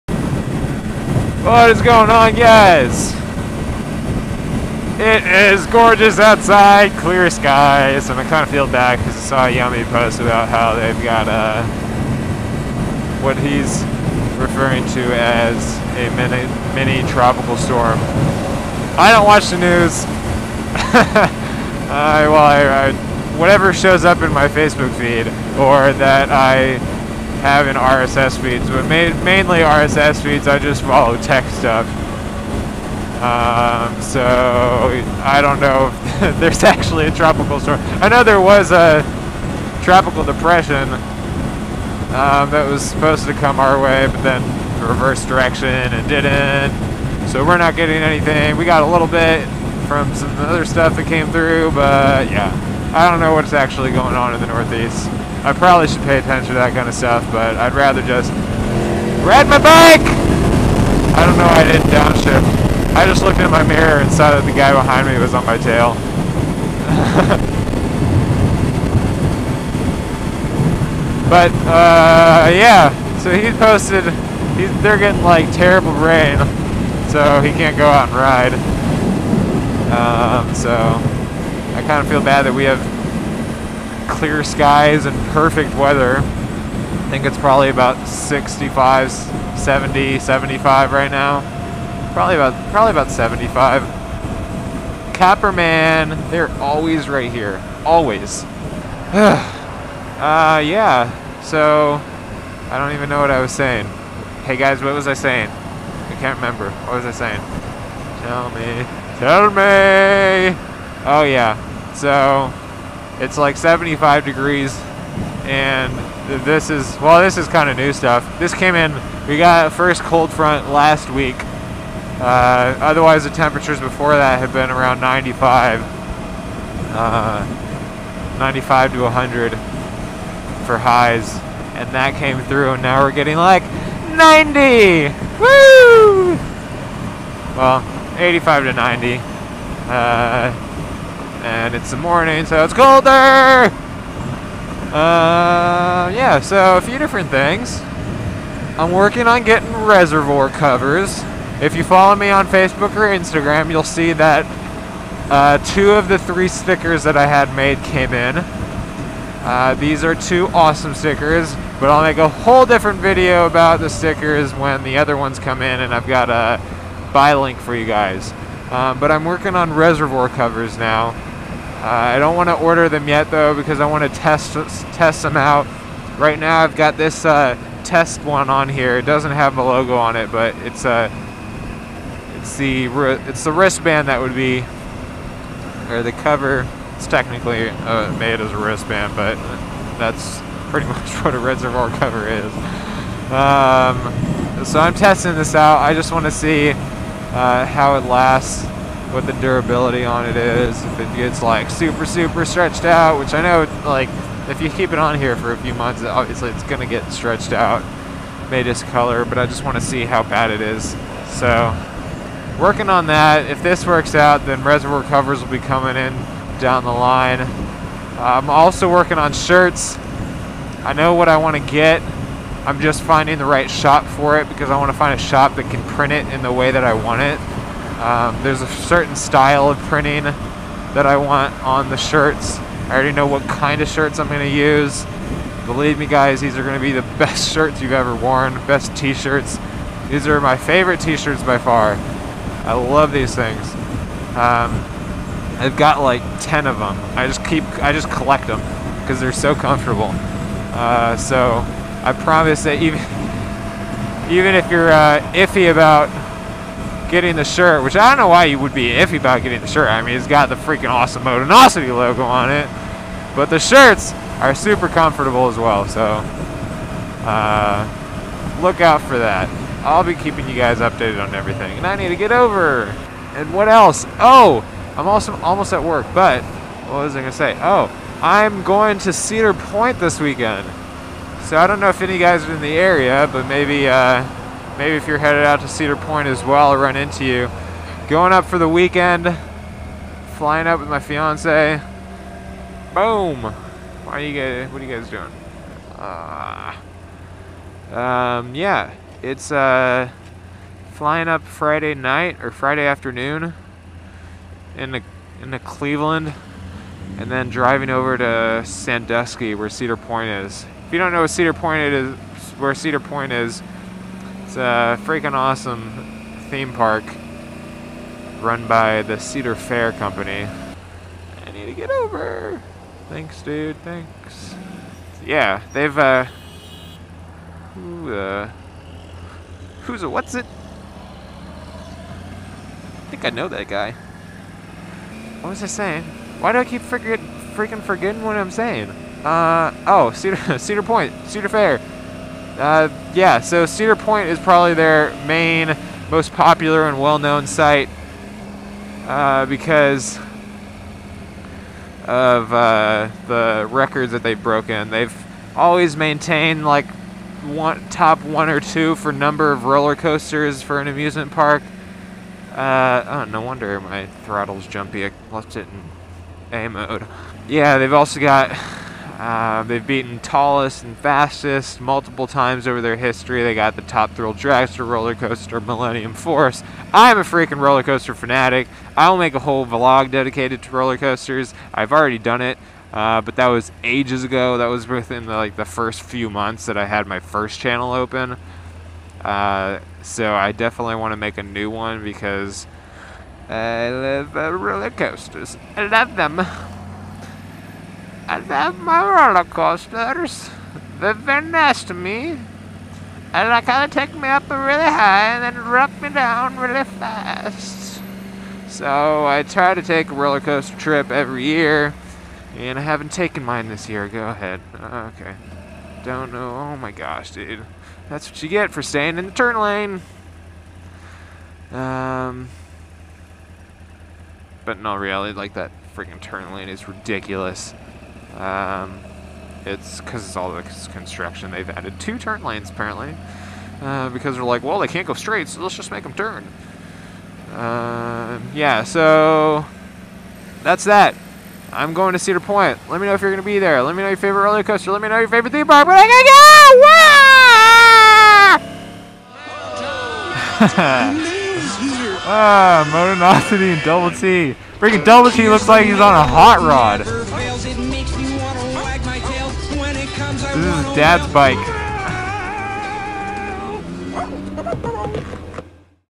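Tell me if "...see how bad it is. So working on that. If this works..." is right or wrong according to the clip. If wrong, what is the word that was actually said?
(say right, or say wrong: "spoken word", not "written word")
right.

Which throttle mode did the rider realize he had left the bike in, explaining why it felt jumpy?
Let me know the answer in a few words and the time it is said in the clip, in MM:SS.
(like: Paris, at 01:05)
A mode, at 06:06.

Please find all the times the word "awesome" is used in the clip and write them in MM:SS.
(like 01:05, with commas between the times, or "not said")
02:40, 04:20, 05:15.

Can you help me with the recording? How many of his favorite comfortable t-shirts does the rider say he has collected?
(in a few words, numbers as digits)
10.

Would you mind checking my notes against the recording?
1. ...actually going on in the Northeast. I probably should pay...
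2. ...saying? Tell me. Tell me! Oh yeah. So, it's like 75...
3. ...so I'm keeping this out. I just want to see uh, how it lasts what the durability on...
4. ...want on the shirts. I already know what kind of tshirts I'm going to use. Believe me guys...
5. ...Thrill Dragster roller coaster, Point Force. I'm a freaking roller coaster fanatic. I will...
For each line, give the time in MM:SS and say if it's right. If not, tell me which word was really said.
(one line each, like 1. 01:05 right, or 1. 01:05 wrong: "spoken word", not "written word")
1. 00:53 right
2. 01:47 right
3. 03:14 wrong: "testing", not "keeping"
4. 03:51 wrong: "shirts", not "tshirts"
5. 06:14 wrong: "Millennium", not "Point".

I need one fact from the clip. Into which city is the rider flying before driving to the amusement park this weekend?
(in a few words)
Cleveland.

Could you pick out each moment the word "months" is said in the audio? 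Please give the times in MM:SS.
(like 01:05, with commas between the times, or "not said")
03:25, 06:26.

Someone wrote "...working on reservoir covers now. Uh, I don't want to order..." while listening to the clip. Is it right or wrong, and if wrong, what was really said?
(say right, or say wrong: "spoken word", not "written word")
right.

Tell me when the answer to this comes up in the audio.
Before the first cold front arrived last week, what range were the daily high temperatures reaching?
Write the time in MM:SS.
02:08.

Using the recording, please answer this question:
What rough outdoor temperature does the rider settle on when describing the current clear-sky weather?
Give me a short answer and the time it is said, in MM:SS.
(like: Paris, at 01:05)
75, at 01:32.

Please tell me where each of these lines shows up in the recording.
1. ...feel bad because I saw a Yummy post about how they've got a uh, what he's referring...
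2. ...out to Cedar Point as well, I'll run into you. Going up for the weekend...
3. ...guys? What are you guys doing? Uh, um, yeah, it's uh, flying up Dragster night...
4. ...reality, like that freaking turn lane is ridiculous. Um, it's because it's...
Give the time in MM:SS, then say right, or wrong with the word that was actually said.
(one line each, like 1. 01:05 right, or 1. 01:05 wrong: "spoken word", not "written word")
1. 00:08 right
2. 04:45 right
3. 04:54 wrong: "Friday", not "Dragster"
4. 07:04 right.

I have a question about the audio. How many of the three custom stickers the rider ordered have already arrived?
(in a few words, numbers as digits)
2.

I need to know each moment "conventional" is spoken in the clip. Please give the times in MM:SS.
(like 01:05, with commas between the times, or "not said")
not said.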